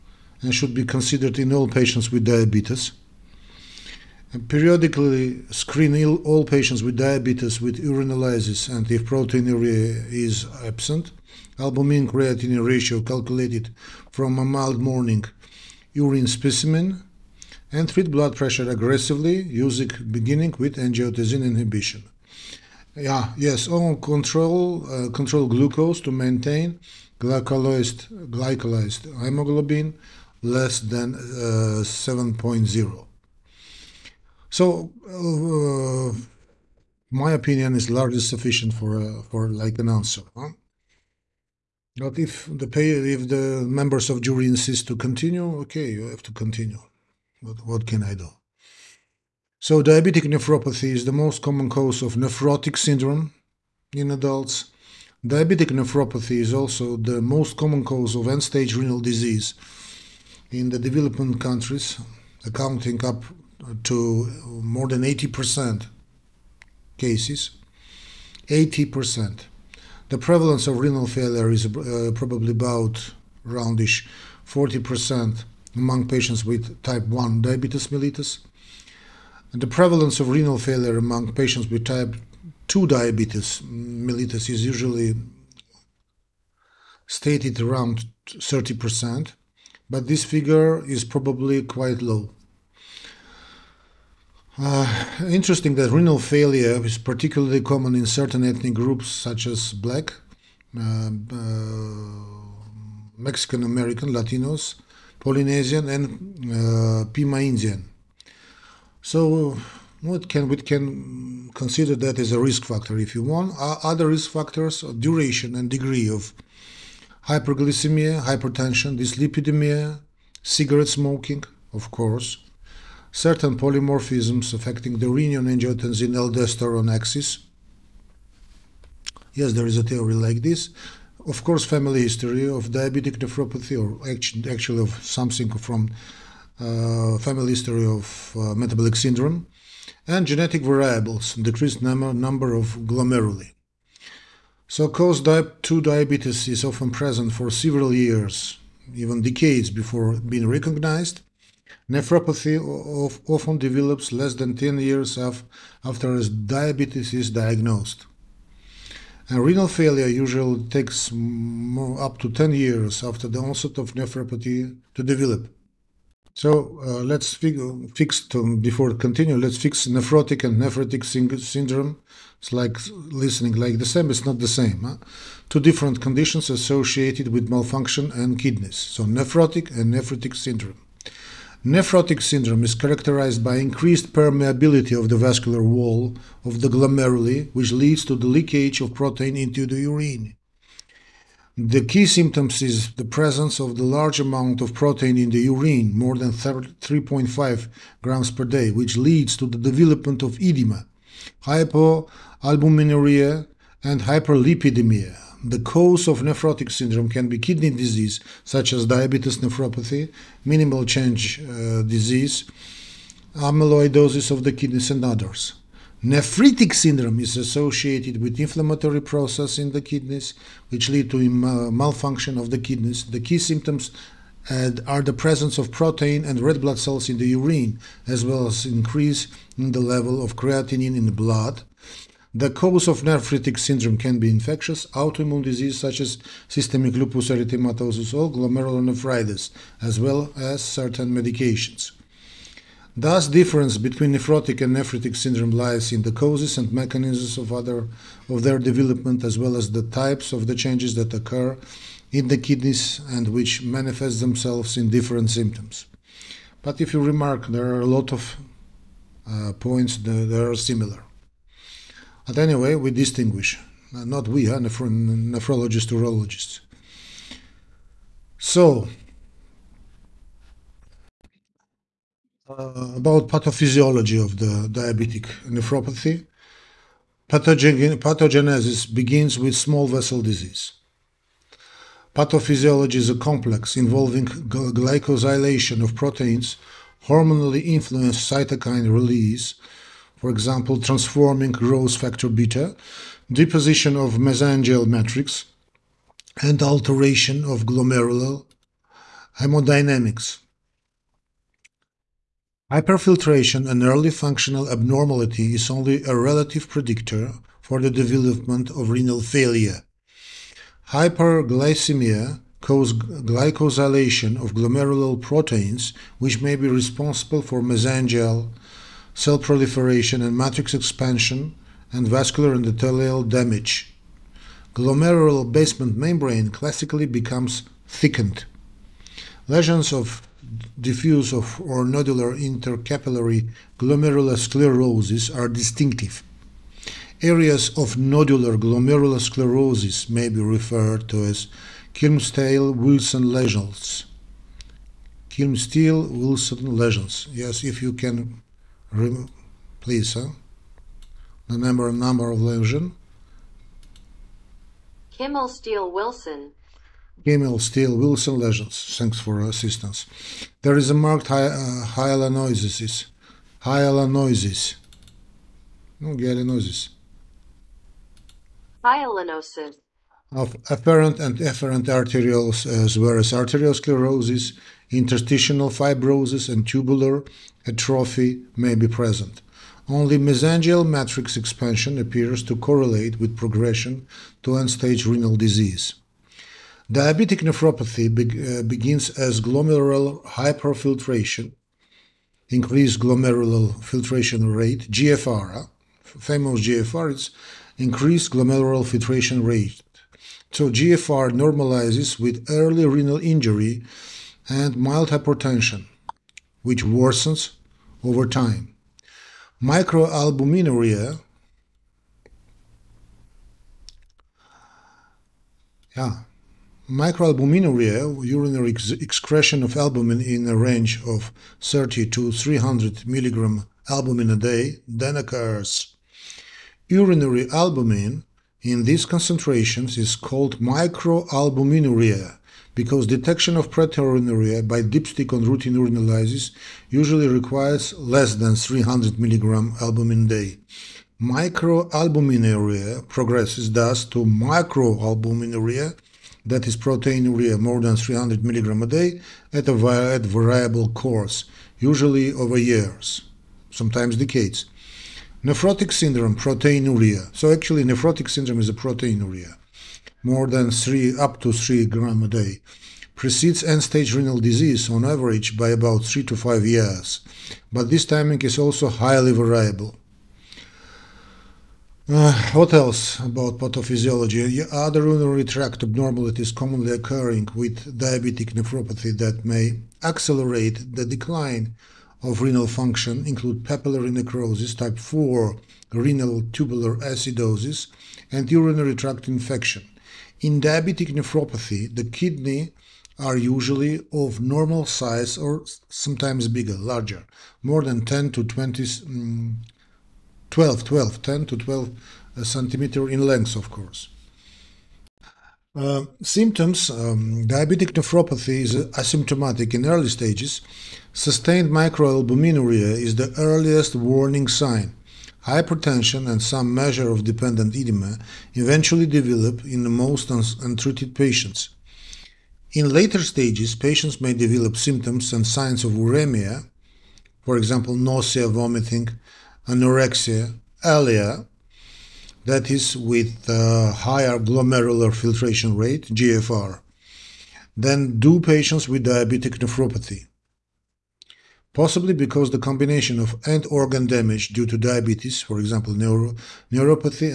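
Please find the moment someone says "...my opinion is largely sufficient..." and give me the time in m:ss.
0:37.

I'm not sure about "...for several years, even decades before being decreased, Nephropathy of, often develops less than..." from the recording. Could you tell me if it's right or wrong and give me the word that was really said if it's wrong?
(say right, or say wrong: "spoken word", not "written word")
wrong: "recognized", not "decreased".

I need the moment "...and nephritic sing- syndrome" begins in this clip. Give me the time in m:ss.
2:50.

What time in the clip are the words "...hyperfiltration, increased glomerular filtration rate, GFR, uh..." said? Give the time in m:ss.
6:30.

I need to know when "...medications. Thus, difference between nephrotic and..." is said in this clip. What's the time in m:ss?
4:01.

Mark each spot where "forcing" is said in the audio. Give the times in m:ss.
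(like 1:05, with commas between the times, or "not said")
not said.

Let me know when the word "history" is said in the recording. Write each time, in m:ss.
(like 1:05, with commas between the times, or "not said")
2:12, 2:17.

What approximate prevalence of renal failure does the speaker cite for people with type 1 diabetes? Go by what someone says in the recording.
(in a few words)
40%.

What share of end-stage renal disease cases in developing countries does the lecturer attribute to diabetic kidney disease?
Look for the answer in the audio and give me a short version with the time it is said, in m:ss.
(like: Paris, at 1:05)
more than 80%, at 1:04.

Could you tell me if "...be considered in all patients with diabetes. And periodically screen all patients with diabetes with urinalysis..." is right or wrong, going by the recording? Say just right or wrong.
right.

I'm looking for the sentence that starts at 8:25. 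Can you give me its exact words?
Uh, symptoms um, Diabetic nephropathy is asymptomatic in early stages.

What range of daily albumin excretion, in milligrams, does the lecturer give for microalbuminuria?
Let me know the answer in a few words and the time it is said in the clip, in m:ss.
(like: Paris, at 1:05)
30 to 300 mg, at 7:01.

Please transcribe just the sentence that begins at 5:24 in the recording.
Glomerular basement membrane classically becomes thickened.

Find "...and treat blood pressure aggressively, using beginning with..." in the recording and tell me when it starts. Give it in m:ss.
0:17.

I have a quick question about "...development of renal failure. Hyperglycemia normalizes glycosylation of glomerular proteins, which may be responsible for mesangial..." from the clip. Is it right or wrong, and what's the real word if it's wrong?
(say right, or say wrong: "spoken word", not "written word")
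wrong: "causes", not "normalizes".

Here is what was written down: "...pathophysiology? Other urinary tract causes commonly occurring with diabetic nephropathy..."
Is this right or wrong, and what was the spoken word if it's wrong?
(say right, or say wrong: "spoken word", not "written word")
wrong: "abnormalities", not "causes".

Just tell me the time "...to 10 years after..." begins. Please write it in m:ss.
2:42.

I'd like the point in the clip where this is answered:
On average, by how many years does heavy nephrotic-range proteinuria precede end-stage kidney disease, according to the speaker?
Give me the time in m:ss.
7:46.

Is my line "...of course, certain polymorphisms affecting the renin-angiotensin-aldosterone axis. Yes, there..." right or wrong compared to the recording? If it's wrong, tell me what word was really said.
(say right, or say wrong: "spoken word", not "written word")
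right.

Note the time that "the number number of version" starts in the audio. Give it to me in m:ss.
5:51.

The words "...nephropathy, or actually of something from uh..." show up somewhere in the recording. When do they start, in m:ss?
2:13.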